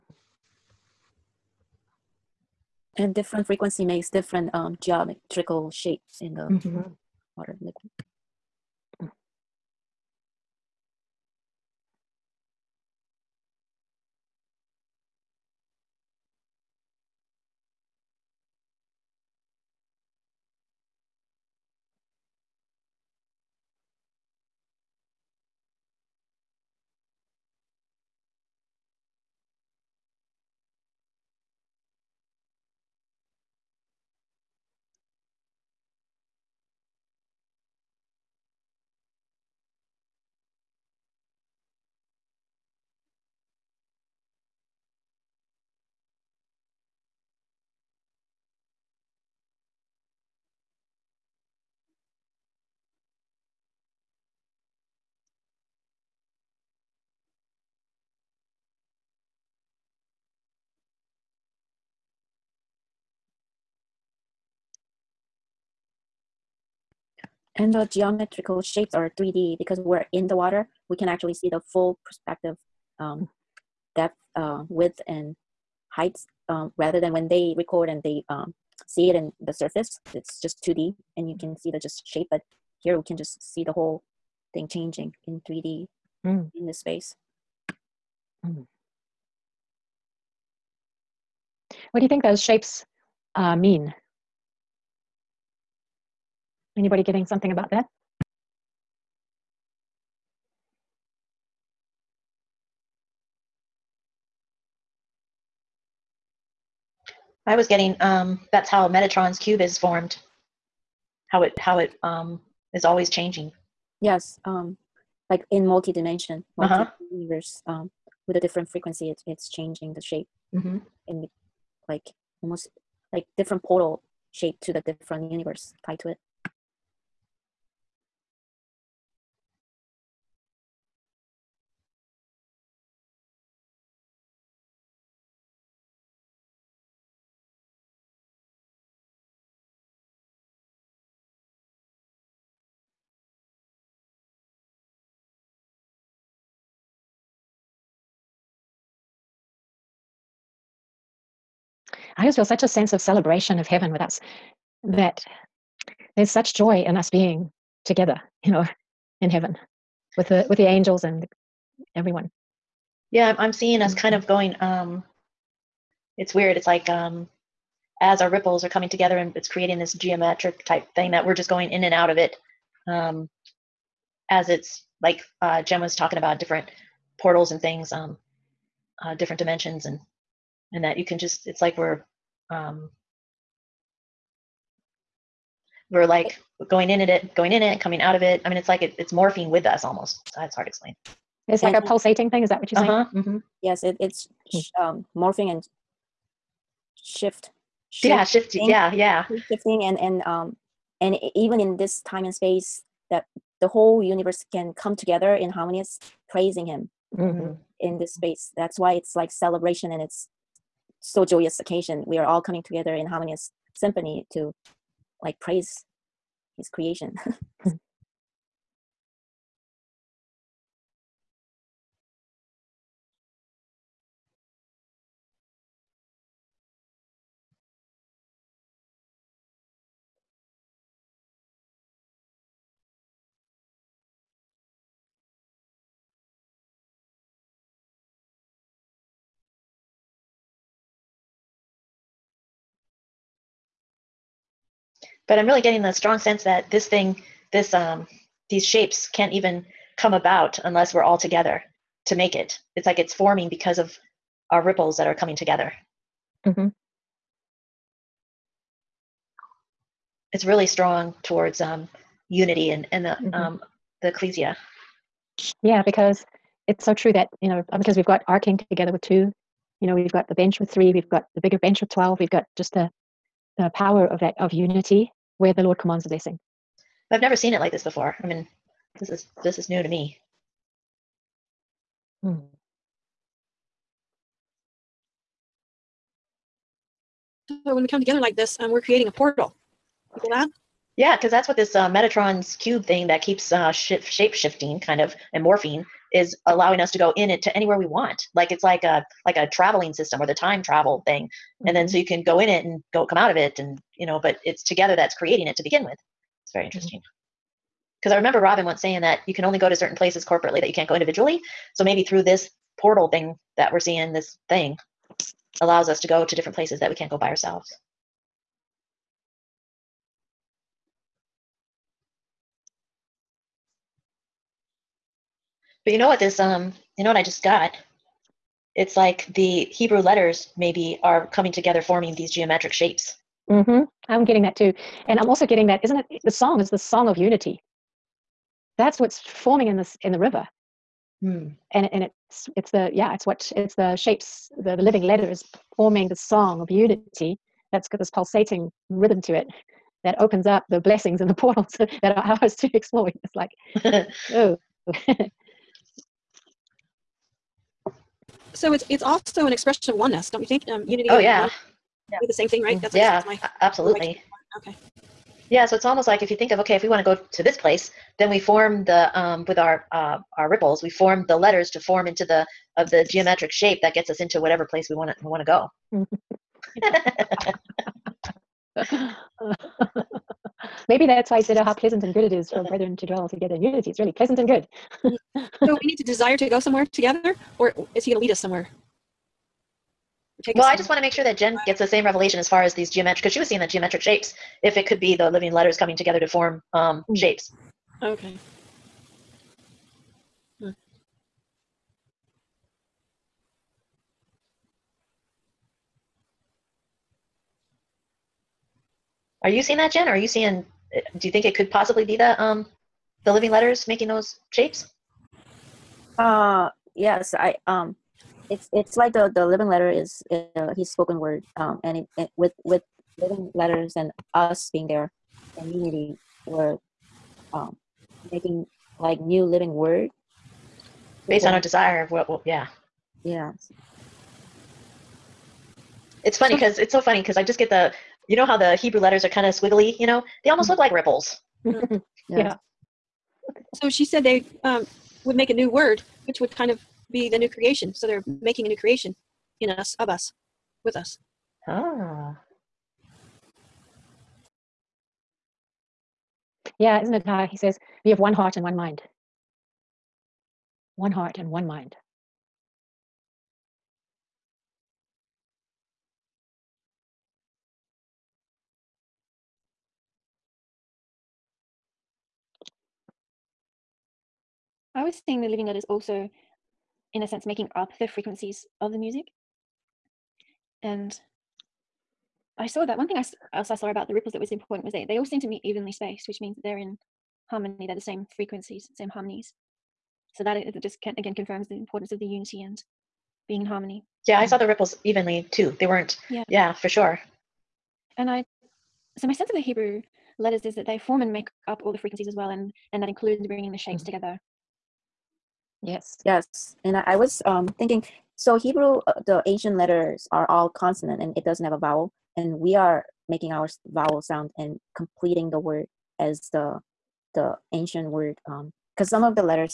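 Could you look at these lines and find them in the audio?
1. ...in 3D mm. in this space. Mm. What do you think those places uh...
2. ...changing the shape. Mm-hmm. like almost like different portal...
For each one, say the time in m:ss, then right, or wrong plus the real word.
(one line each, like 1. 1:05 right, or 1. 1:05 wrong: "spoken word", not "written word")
1. 1:25 wrong: "shapes", not "places"
2. 1:59 right.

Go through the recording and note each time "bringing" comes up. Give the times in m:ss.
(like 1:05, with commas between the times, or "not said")
8:23.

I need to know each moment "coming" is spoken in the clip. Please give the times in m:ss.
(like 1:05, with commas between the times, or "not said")
2:48, 3:07, 3:32, 4:15, 5:31, 6:35.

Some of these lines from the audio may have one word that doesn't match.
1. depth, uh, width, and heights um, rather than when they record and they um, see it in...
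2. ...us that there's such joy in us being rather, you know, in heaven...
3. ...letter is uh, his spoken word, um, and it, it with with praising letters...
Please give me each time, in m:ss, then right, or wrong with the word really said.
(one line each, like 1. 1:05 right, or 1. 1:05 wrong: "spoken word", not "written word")
1. 1:13 right
2. 2:34 wrong: "together", not "rather"
3. 6:59 wrong: "living", not "praising".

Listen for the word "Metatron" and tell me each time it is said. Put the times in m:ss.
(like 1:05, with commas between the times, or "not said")
1:48, 4:51.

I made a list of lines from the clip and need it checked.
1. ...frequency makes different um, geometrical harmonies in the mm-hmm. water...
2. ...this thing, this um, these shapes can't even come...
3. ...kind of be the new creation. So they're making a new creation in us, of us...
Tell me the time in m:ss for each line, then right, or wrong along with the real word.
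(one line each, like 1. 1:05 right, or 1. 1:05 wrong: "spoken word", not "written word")
1. 0:03 wrong: "shapes", not "harmonies"
2. 4:06 right
3. 7:26 right.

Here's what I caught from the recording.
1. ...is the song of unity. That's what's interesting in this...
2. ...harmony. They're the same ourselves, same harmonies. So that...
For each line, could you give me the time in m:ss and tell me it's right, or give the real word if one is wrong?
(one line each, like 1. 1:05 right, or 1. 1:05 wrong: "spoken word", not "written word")
1. 5:36 wrong: "forming", not "interesting"
2. 8:07 wrong: "frequencies", not "ourselves".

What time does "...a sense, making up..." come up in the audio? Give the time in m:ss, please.
7:57.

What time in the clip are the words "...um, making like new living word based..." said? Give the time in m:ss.
7:07.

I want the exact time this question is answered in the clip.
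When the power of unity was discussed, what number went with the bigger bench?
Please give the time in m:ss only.
4:31.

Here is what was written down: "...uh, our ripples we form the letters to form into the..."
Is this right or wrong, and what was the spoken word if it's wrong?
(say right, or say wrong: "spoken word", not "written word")
right.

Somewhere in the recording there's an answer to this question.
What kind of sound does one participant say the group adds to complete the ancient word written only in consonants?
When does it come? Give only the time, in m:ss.
8:33.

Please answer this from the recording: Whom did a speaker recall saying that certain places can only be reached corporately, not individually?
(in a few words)
Robin.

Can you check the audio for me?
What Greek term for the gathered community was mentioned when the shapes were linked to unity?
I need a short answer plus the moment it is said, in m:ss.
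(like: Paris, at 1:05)
ecclesia, at 4:24.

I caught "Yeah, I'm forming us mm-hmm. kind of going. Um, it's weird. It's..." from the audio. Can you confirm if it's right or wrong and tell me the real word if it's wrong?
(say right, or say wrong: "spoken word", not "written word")
wrong: "seeing", not "forming".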